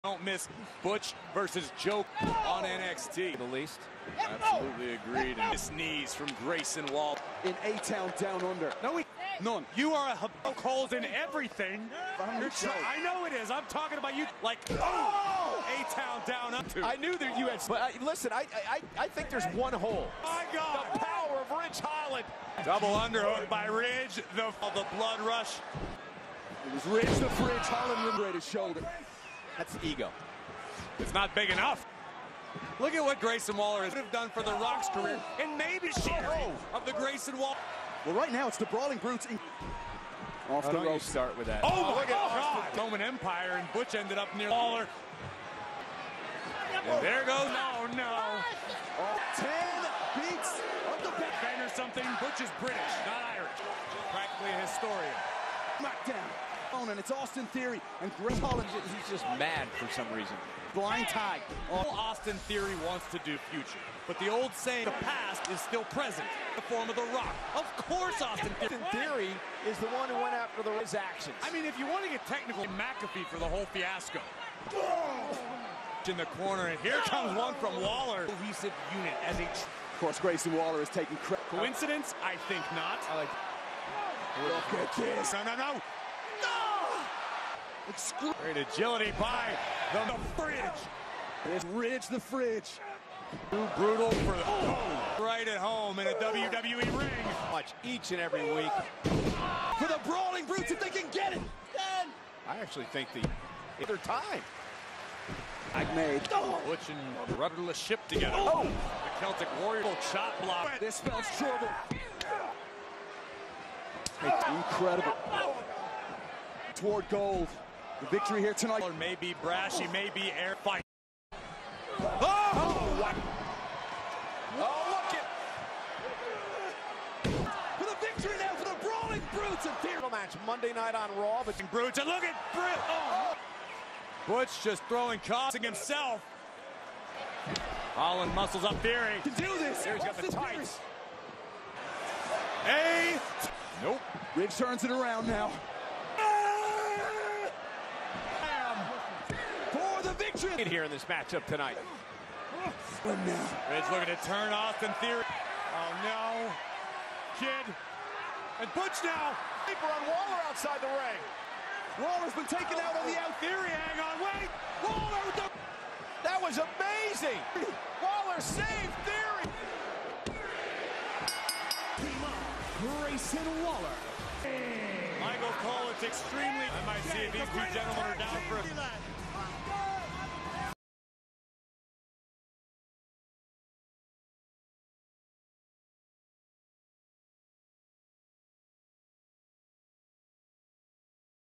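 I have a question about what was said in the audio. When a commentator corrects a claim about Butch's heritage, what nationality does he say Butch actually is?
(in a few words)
British.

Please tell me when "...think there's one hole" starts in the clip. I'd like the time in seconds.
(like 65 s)
19 s.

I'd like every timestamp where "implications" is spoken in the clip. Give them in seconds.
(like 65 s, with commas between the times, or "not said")
not said.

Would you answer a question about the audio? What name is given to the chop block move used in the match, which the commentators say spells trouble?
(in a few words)
Celtic Warrior chop block.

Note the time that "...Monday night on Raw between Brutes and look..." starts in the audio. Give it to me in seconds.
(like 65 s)
130 s.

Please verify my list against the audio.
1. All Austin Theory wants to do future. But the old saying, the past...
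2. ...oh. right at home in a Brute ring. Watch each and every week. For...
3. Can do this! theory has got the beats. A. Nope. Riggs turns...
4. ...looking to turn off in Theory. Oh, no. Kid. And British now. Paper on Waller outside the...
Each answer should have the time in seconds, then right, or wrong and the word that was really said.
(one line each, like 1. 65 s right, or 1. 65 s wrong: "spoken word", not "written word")
1. 61 s right
2. 94 s wrong: "WWE", not "Brute"
3. 139 s wrong: "tights", not "beats"
4. 153 s wrong: "Butch", not "British".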